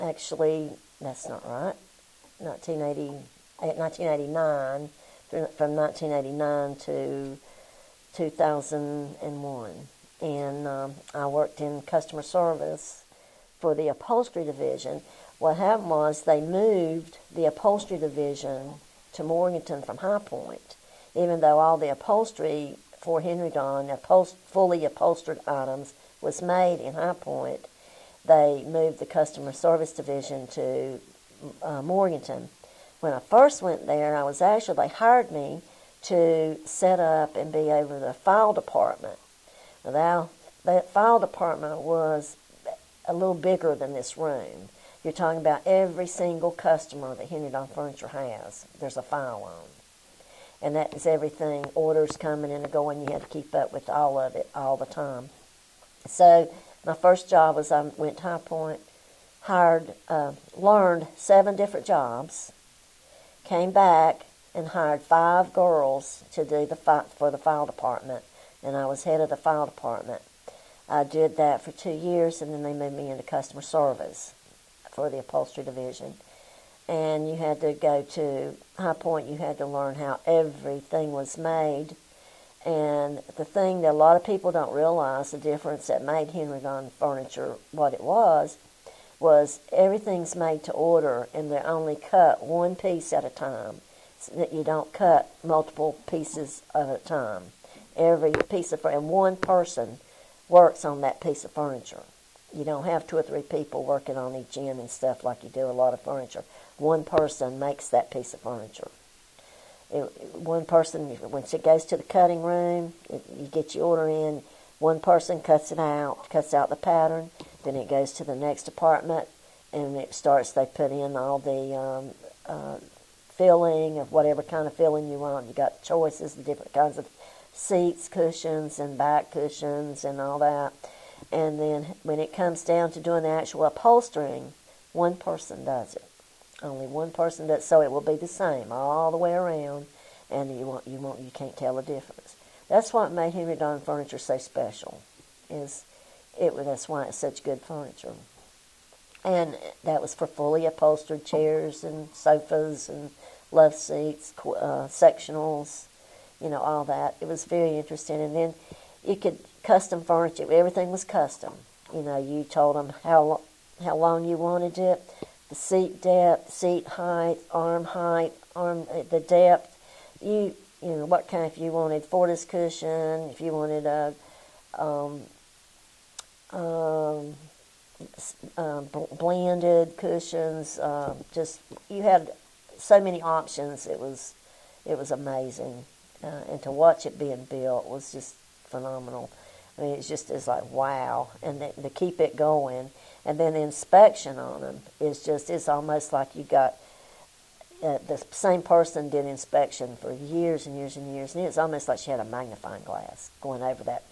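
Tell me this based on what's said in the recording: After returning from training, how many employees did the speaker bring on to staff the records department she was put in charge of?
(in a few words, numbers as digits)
5.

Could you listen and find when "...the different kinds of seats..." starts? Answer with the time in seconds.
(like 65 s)
126 s.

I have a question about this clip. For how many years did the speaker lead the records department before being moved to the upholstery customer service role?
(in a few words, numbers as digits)
2.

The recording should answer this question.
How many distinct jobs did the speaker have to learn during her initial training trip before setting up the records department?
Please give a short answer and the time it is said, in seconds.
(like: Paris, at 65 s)
7, at 61 s.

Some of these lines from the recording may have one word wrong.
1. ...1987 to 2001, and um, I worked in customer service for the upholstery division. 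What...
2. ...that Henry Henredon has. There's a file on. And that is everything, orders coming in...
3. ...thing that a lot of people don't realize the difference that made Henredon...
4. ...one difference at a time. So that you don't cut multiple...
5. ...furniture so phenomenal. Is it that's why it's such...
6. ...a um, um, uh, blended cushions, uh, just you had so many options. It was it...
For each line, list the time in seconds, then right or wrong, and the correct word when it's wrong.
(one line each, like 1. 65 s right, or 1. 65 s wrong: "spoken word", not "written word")
1. 5 s wrong: "1989", not "1987"
2. 47 s wrong: "Furniture", not "Henredon"
3. 83 s right
4. 92 s wrong: "piece", not "difference"
5. 143 s wrong: "special", not "phenomenal"
6. 173 s right.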